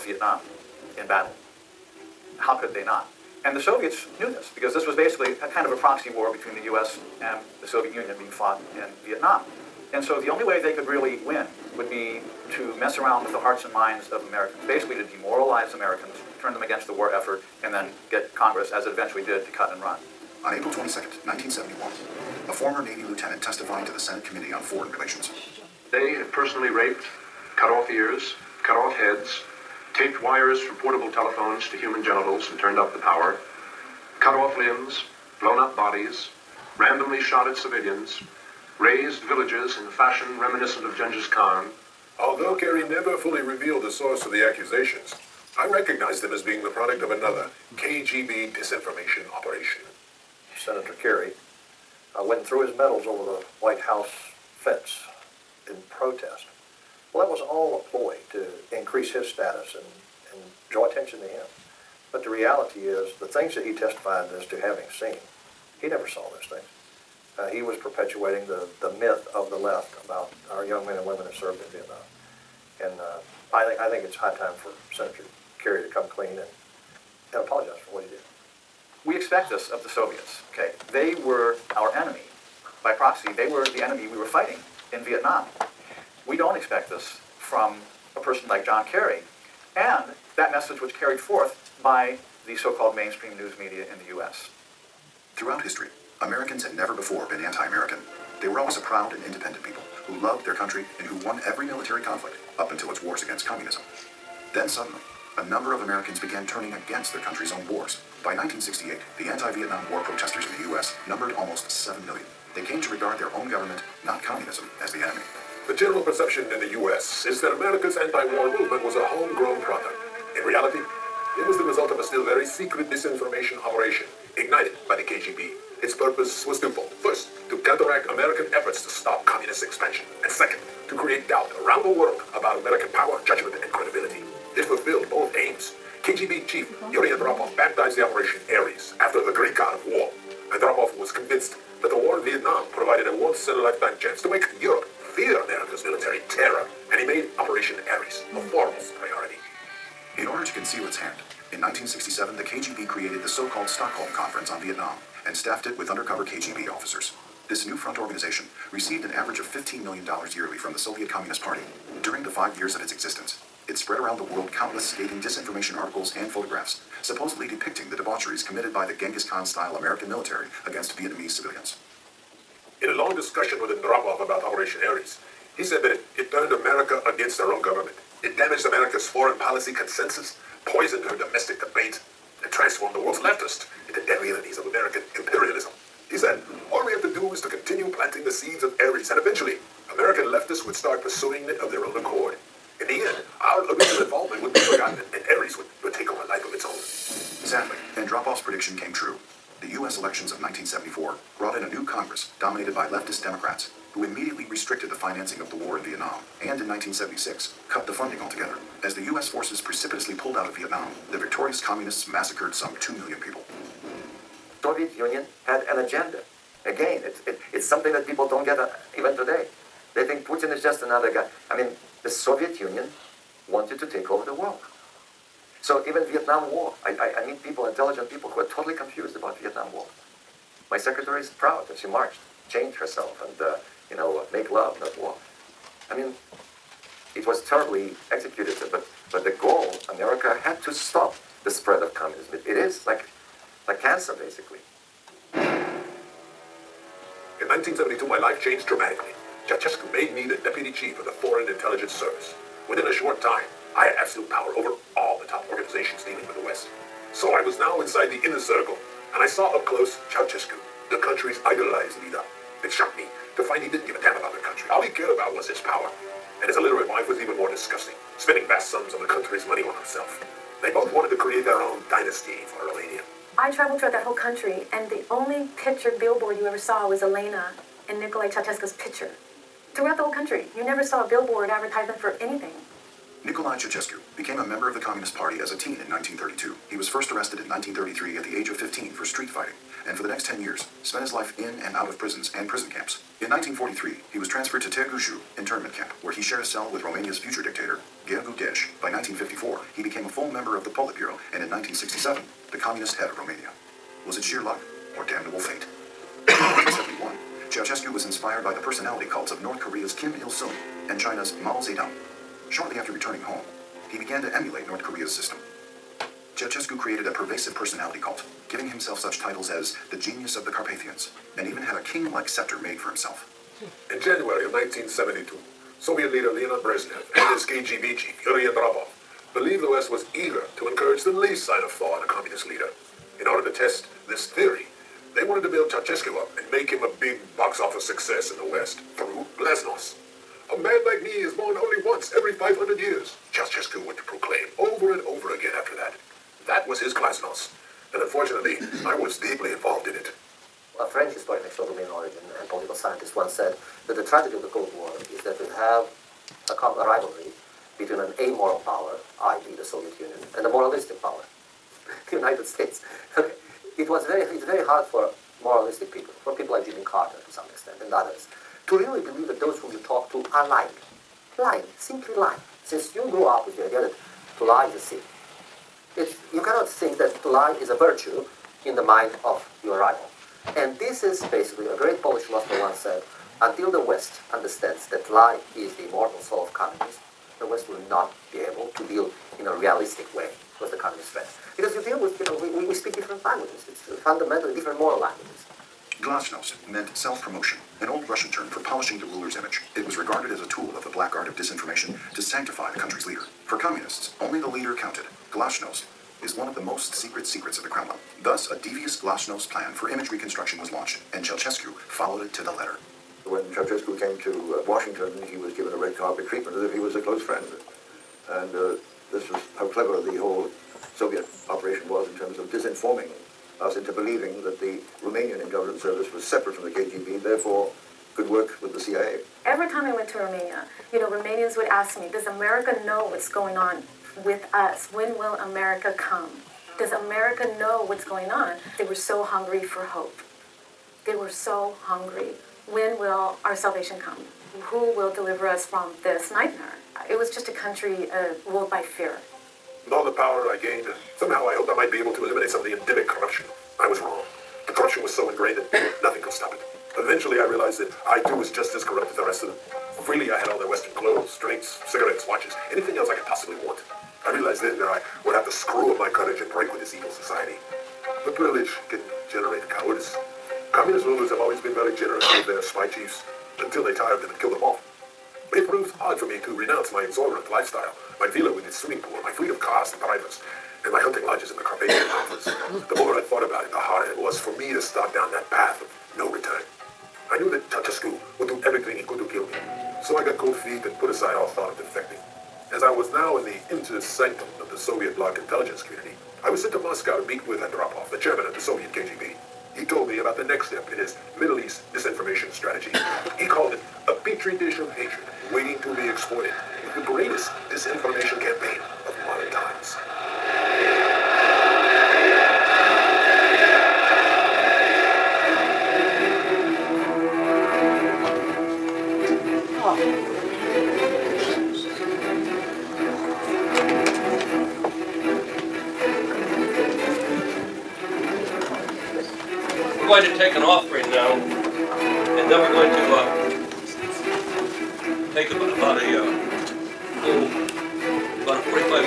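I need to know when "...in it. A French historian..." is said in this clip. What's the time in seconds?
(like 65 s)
349 s.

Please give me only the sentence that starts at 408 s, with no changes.
Thus, a devious glasnost plan for image reconstruction was launched, and Ceausescu followed it to the letter.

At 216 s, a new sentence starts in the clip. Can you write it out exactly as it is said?
Again, it, it, it's something that people don't get uh, even today.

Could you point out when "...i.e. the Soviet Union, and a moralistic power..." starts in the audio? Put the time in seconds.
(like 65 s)
359 s.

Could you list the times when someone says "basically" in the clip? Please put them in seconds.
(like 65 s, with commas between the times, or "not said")
4 s, 14 s, 244 s, 381 s.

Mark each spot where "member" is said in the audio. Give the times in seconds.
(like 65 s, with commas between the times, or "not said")
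284 s, 300 s.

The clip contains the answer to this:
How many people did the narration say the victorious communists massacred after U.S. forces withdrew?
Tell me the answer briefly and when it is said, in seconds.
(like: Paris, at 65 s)
2 million, at 212 s.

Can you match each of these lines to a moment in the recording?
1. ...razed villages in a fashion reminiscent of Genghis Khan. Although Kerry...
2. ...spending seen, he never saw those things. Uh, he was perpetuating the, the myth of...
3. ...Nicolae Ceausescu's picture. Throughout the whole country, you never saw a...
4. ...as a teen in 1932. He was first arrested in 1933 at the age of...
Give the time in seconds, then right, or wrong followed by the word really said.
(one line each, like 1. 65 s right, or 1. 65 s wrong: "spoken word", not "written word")
1. 38 s right
2. 64 s wrong: "having", not "spending"
3. 277 s right
4. 285 s right.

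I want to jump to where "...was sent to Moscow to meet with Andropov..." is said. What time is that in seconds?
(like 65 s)
496 s.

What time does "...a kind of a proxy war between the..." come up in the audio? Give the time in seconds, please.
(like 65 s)
5 s.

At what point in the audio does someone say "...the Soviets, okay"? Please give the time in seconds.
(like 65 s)
79 s.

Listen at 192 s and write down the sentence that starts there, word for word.
In the end, our original involvement would be forgotten, and Ares would, would take on a life of its own.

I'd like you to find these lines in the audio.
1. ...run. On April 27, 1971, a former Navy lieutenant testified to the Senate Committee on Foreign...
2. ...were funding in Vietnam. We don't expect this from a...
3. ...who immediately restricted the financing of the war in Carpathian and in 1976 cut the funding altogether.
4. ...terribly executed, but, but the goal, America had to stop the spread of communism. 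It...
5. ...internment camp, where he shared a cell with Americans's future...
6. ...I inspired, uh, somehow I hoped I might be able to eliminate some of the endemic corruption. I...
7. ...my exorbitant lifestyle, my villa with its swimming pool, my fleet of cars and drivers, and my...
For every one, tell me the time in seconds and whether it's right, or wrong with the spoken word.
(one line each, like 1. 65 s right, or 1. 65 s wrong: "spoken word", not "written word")
1. 19 s wrong: "22", not "27"
2. 84 s wrong: "fighting", not "funding"
3. 203 s wrong: "Vietnam", not "Carpathian"
4. 237 s right
5. 295 s wrong: "Romania", not "Americans"
6. 450 s wrong: "gained", not "inspired"
7. 476 s right.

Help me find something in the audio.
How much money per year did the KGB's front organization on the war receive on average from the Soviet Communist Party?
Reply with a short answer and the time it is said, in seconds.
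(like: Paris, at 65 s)
$15 million, at 159 s.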